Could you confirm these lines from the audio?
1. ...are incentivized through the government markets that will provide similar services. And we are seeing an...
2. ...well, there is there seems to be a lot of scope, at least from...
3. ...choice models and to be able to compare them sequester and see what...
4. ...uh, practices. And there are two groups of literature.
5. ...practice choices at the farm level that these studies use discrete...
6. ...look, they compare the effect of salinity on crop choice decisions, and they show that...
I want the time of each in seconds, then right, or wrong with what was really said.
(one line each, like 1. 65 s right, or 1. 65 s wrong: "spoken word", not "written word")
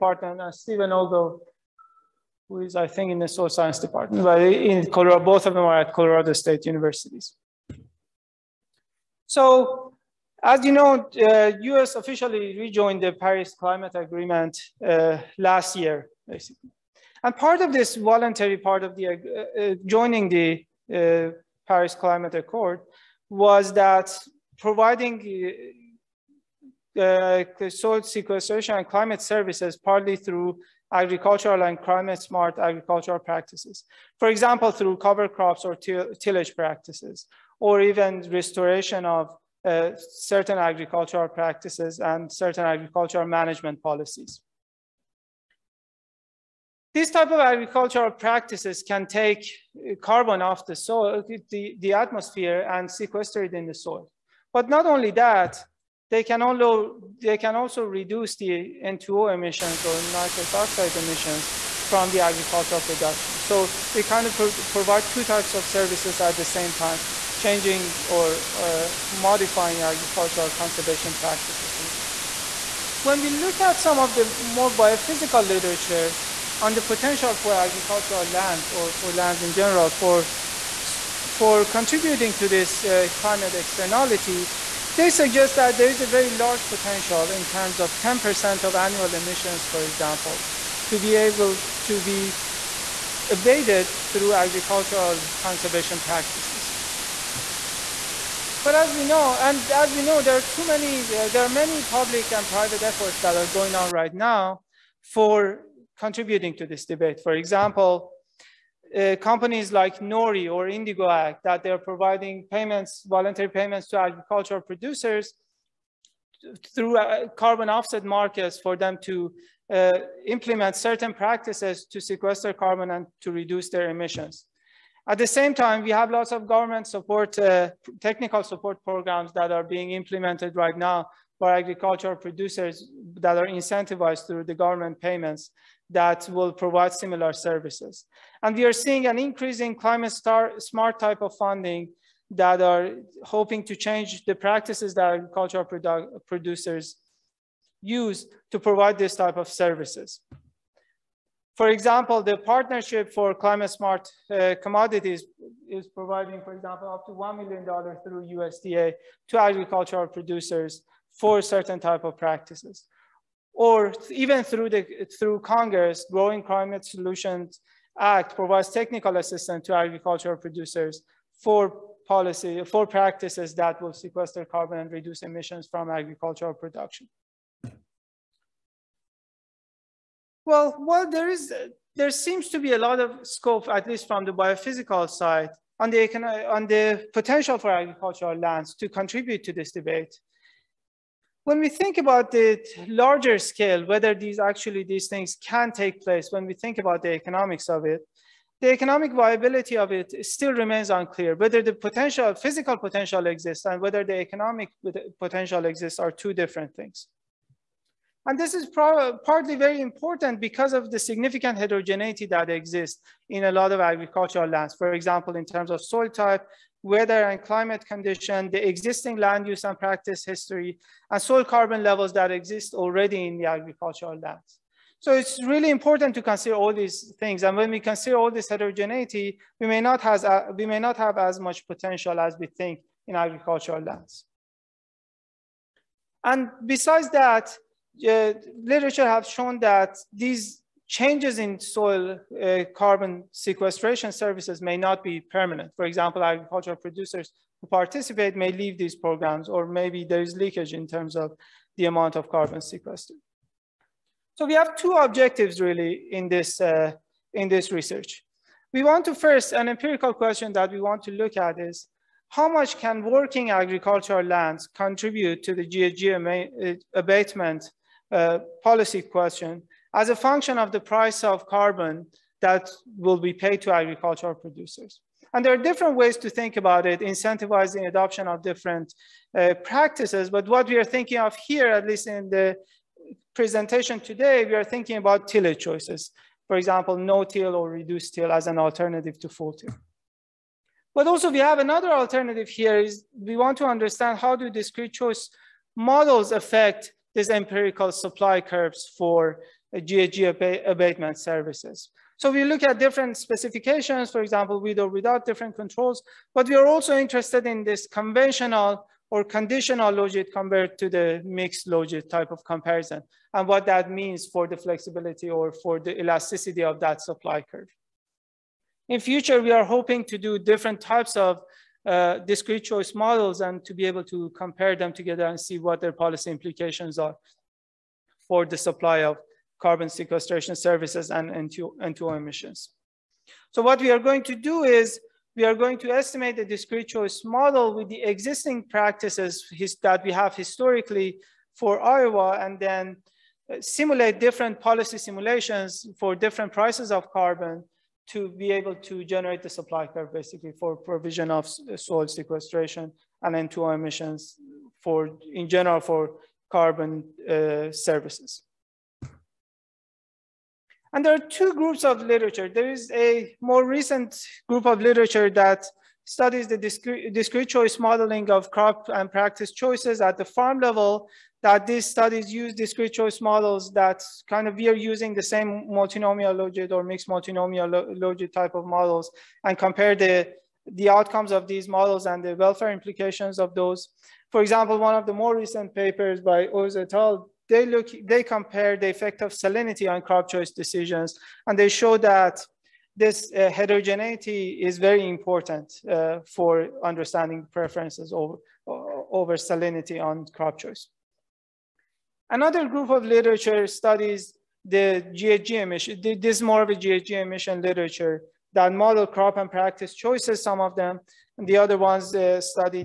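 1. 133 s wrong: "payments", not "markets"
2. 180 s right
3. 322 s wrong: "together", not "sequester"
4. 357 s wrong: "services", not "practices"
5. 369 s right
6. 387 s right.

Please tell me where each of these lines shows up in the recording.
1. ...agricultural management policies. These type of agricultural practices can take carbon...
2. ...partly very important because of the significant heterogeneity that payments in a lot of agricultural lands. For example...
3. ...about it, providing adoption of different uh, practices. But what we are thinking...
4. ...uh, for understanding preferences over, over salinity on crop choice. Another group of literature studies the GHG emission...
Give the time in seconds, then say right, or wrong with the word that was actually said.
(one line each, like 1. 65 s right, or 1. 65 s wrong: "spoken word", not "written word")
1. 42 s right
2. 208 s wrong: "exists", not "payments"
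3. 276 s wrong: "incentivizing", not "providing"
4. 395 s right.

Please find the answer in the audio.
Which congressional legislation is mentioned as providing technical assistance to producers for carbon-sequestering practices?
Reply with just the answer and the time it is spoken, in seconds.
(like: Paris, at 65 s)
Growing Climate Solutions Act, at 166 s.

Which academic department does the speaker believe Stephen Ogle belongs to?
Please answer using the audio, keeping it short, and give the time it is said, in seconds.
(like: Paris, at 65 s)
Soil Science Department, at 3 s.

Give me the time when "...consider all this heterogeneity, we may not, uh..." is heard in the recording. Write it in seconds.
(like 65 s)
227 s.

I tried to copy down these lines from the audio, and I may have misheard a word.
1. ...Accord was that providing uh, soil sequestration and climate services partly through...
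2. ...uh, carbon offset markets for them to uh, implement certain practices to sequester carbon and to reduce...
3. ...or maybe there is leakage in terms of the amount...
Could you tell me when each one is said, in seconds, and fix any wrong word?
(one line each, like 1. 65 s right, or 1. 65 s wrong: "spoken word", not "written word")
1. 22 s right
2. 116 s right
3. 249 s right.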